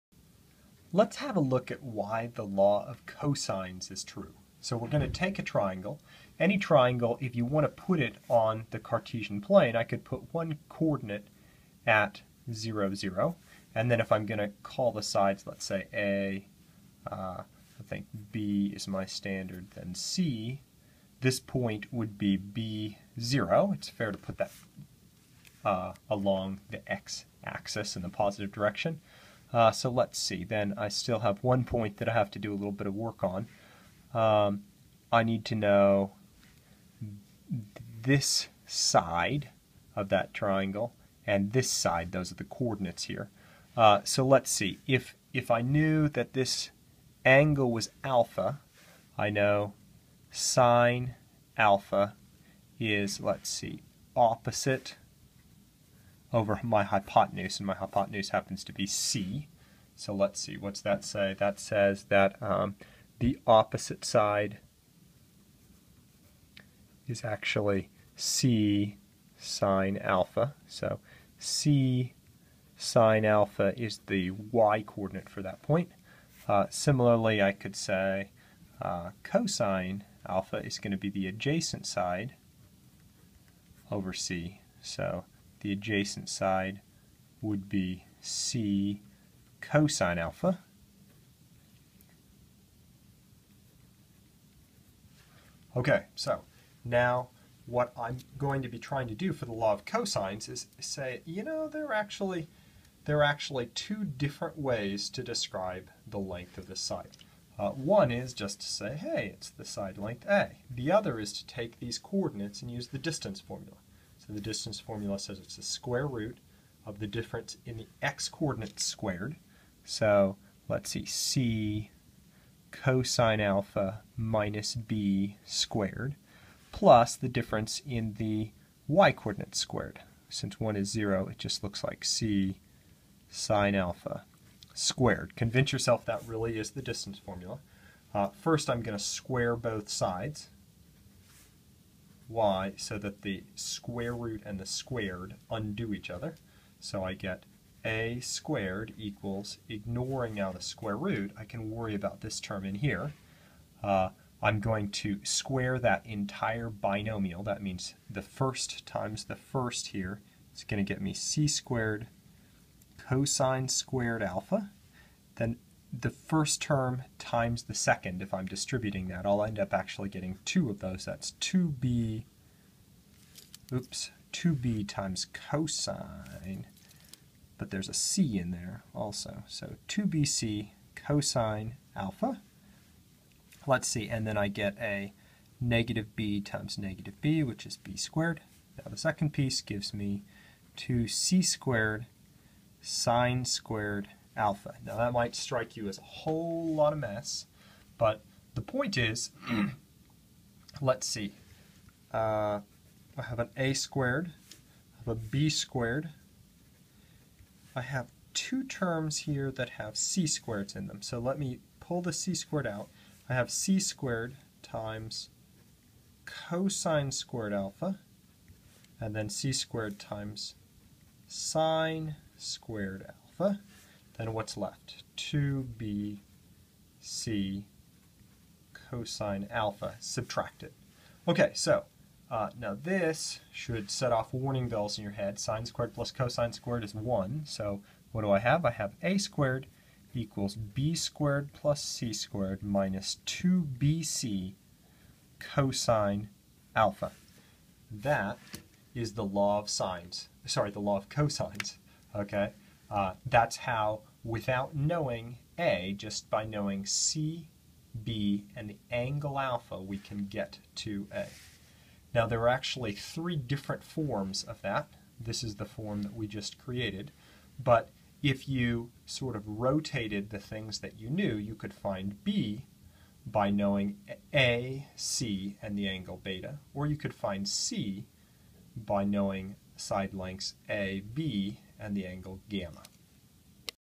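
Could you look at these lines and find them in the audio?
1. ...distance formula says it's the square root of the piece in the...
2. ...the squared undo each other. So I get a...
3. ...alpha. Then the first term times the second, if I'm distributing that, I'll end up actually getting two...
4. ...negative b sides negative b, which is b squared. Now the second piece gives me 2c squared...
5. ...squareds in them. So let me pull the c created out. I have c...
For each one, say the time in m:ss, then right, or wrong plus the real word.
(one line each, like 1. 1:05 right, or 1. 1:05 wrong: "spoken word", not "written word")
1. 1:54 wrong: "difference", not "piece"
2. 2:24 right
3. 2:44 right
4. 3:05 wrong: "times", not "sides"
5. 3:30 wrong: "squared", not "created".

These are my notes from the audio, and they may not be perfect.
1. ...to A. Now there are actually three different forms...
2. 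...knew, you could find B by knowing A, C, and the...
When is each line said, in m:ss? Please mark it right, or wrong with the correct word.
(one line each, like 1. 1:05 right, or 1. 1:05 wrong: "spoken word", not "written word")
1. 4:20 right
2. 4:31 right.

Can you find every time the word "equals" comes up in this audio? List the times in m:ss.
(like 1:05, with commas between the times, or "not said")
2:28, 4:00.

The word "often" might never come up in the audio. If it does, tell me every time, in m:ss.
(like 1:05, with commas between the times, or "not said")
not said.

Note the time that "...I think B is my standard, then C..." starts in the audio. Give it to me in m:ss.
0:17.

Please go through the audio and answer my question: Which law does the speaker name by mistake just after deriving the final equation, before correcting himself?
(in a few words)
law of sines.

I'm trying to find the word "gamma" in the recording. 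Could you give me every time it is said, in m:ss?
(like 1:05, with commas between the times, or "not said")
4:42.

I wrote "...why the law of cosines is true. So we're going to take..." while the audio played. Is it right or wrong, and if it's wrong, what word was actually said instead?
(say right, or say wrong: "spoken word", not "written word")
right.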